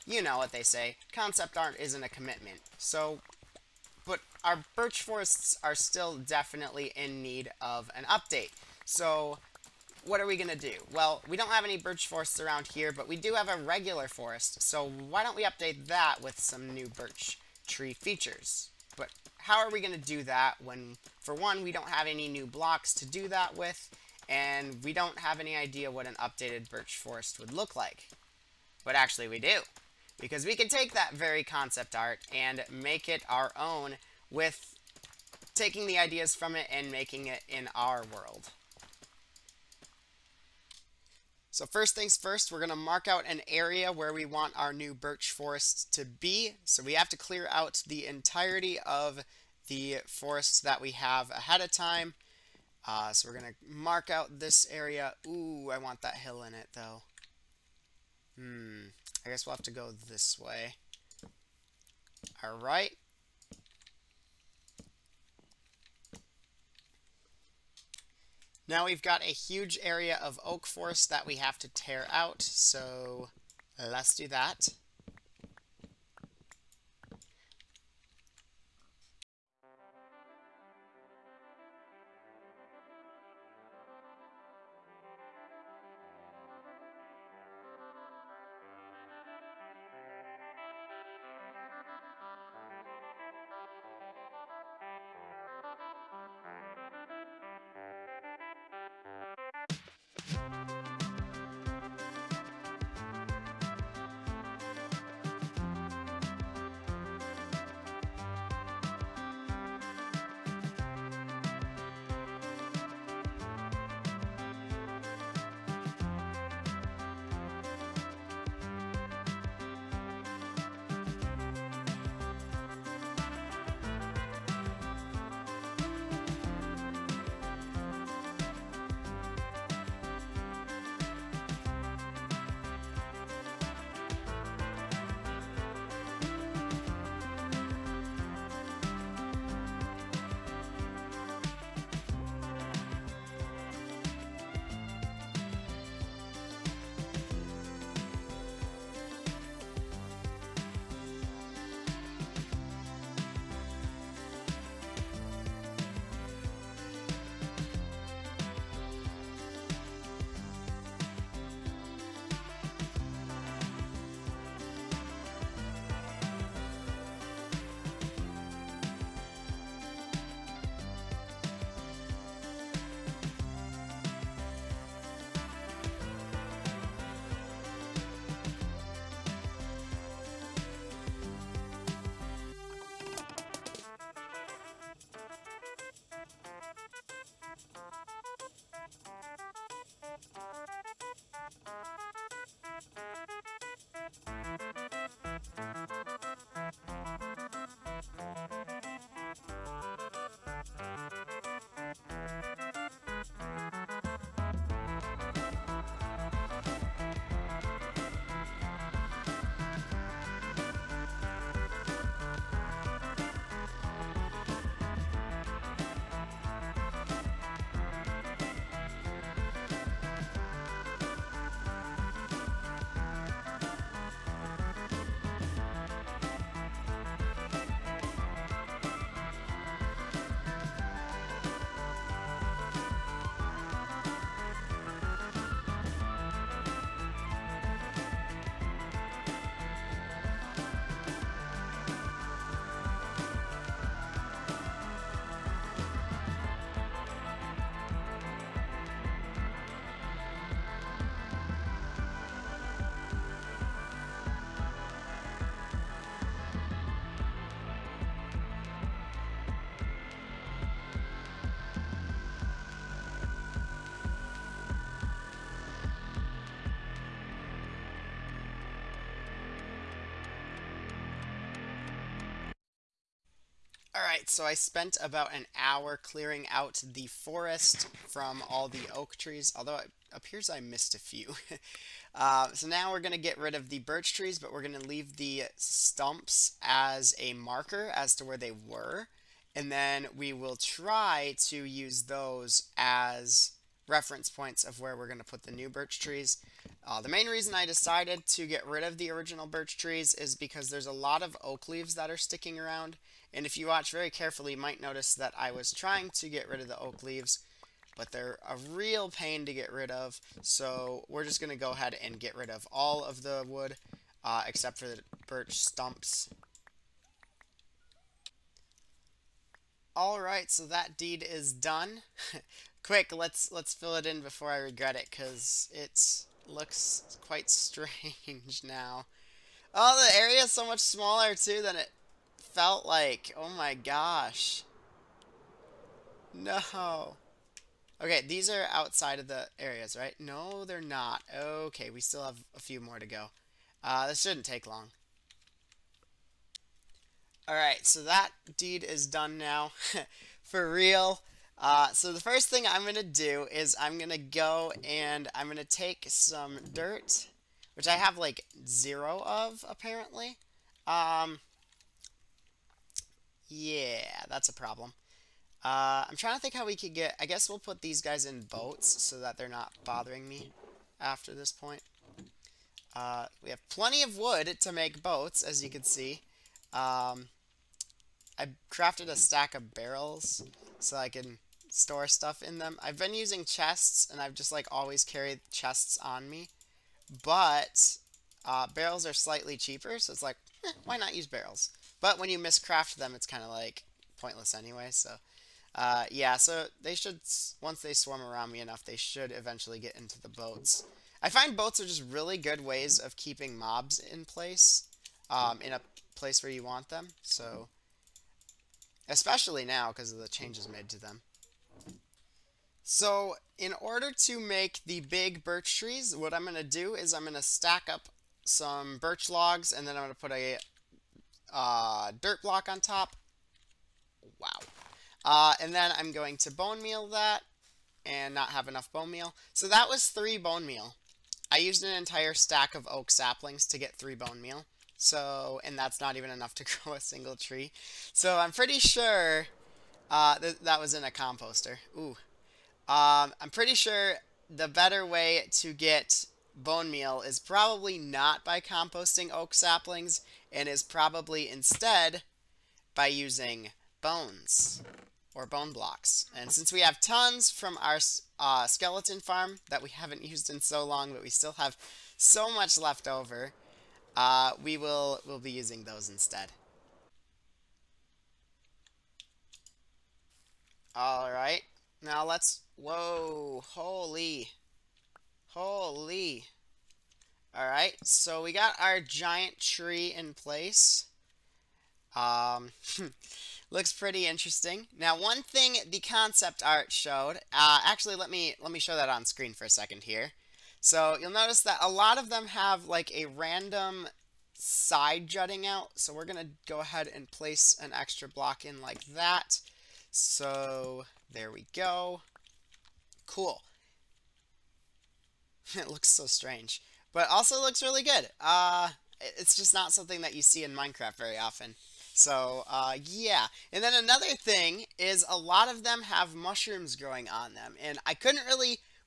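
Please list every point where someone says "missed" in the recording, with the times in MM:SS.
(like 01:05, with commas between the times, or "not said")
04:40.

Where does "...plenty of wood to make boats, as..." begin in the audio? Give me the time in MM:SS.
06:13.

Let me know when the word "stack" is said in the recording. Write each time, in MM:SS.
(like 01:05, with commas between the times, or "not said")
06:19, 06:57, 07:12.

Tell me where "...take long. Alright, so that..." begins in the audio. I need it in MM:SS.
05:44.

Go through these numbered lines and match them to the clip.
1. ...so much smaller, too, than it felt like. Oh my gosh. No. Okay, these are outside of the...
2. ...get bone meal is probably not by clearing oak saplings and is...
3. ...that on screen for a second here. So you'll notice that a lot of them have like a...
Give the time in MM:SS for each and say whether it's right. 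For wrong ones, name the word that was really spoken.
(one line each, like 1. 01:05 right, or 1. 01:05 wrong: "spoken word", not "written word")
1. 05:30 right
2. 07:25 wrong: "composting", not "clearing"
3. 08:08 right.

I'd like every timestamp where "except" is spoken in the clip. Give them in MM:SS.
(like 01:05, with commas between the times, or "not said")
05:14.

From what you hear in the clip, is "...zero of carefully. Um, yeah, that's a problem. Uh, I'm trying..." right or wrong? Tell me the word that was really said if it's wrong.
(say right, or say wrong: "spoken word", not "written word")
wrong: "apparently", not "carefully".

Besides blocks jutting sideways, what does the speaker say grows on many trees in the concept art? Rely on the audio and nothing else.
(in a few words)
mushrooms.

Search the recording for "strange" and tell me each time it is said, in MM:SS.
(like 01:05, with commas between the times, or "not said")
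05:27, 08:26.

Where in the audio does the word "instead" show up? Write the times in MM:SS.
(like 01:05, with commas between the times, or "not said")
07:31, 07:46.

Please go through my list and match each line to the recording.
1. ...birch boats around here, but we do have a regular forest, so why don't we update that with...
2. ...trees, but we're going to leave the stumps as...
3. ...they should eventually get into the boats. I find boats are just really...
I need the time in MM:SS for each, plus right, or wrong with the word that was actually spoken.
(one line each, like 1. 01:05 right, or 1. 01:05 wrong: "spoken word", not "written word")
1. 00:11 wrong: "forests", not "boats"
2. 04:44 right
3. 06:38 right.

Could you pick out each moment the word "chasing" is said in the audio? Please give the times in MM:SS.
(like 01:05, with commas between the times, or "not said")
not said.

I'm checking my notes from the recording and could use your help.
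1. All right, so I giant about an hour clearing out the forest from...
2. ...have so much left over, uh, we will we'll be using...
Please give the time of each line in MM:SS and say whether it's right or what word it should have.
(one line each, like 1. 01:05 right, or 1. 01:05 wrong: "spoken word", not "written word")
1. 04:33 wrong: "spent", not "giant"
2. 07:41 right.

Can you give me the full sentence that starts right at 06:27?
But uh, barrels are slightly cheaper, so it's like, eh, why not use barrels?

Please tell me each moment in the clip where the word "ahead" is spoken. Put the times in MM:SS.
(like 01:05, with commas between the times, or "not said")
00:51, 05:11, 08:16.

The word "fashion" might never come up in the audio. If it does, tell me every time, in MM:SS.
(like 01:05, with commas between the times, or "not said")
not said.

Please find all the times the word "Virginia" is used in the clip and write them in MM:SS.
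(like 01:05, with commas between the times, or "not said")
not said.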